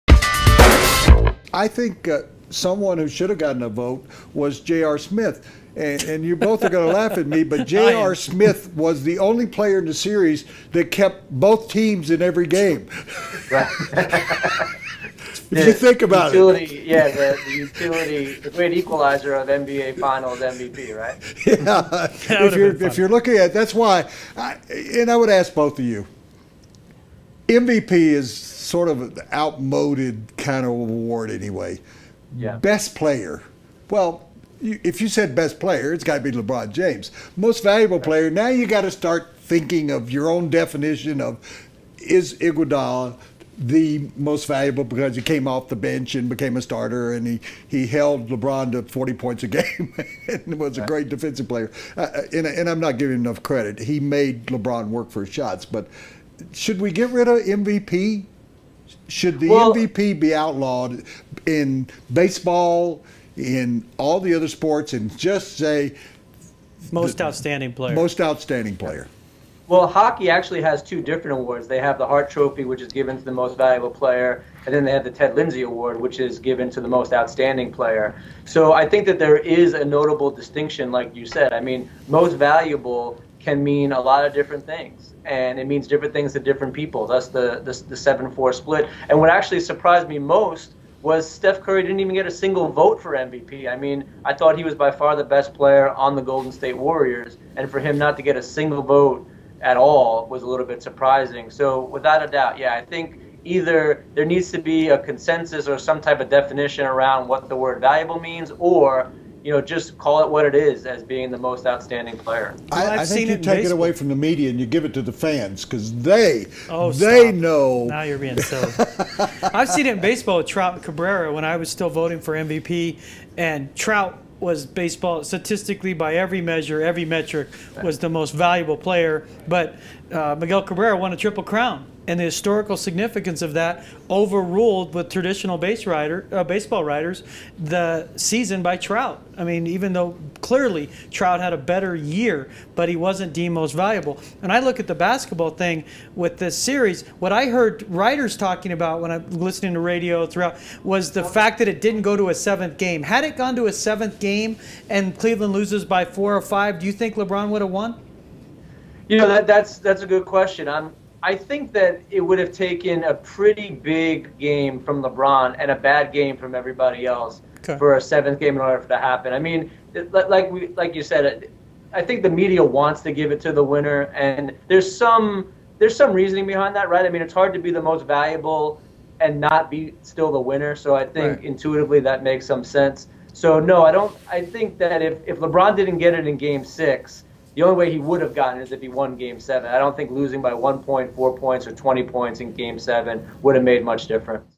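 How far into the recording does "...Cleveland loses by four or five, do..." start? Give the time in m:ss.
2:35.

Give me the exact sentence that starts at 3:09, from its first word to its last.
I don't think losing by one point, four points, or 20 points in Game Seven would have made much difference.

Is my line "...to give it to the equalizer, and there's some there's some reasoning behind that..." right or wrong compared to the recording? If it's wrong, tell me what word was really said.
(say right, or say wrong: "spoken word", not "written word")
wrong: "winner", not "equalizer".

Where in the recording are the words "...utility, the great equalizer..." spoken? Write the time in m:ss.
0:17.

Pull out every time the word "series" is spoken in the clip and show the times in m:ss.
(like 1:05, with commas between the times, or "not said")
0:09, 2:26.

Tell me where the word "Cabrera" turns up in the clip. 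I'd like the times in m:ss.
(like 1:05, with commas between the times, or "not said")
2:00, 2:10.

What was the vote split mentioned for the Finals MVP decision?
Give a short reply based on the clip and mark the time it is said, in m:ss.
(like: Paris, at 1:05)
7-4, at 1:27.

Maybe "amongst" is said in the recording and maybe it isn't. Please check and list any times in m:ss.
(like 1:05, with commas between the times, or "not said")
not said.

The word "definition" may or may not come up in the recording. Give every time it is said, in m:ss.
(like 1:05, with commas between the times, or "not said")
0:40, 1:46.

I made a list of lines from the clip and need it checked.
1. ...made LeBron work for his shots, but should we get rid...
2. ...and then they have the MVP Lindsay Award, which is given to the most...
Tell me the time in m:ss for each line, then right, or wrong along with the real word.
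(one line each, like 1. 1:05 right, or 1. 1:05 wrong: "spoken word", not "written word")
1. 0:53 right
2. 1:14 wrong: "Ted", not "MVP".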